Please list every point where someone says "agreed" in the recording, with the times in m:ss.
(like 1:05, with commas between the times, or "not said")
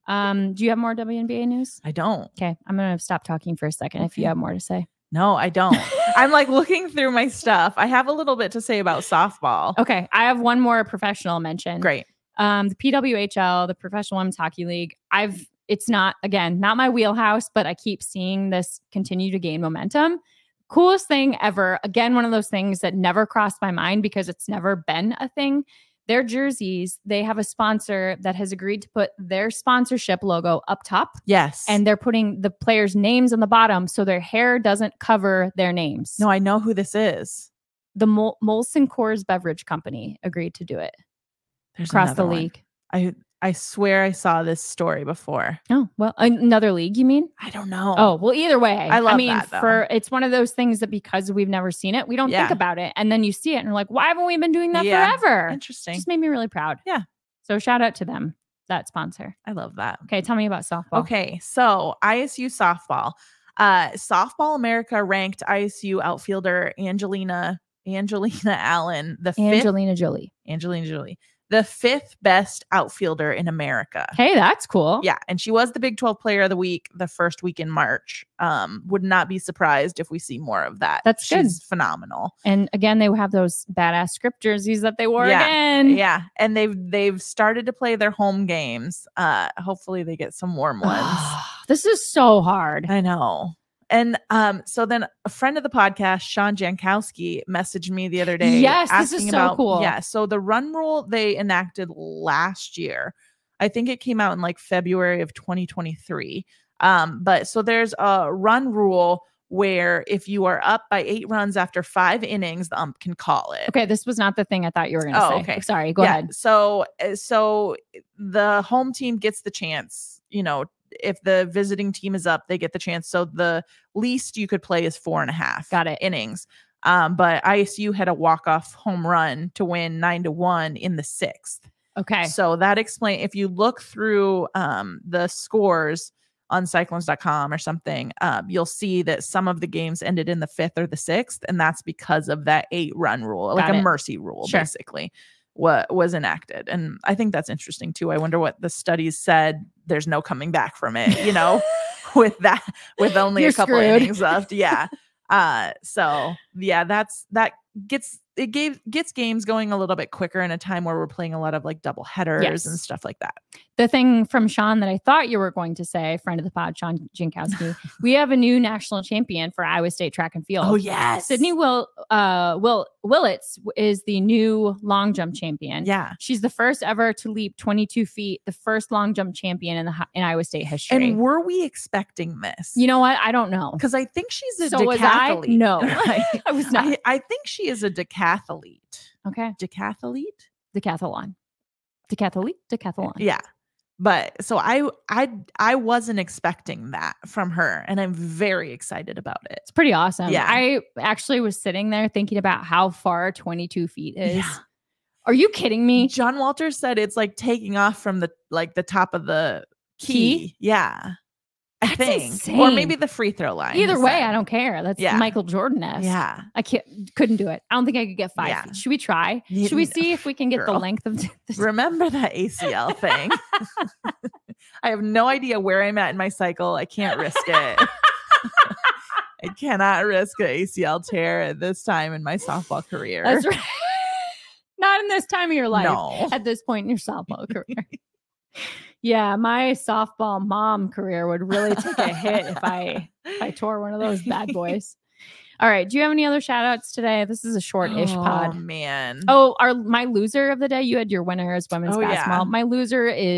0:28, 0:40.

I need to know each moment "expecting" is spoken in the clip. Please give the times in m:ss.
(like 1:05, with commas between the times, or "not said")
3:01, 3:16.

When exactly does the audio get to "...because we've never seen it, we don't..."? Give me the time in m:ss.
0:50.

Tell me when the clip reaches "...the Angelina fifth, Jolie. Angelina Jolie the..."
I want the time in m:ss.
1:09.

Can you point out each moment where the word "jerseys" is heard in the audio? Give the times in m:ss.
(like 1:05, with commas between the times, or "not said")
0:26, 1:24.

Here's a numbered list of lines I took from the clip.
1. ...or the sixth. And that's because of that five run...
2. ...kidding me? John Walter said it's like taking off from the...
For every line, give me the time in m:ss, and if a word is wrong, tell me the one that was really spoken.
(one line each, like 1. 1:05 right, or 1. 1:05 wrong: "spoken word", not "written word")
1. 2:20 wrong: "eight", not "five"
2. 3:25 right.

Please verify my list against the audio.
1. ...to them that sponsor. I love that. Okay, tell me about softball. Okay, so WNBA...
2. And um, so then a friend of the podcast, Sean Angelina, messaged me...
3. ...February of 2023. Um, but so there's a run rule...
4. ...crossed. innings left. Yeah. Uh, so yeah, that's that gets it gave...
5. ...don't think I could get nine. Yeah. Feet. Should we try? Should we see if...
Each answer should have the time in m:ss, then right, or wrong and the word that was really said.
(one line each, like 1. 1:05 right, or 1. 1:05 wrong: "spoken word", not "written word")
1. 0:57 wrong: "ISU", not "WNBA"
2. 1:33 wrong: "Jankowski", not "Angelina"
3. 1:44 right
4. 2:33 wrong: "screwed", not "crossed"
5. 3:37 wrong: "five", not "nine".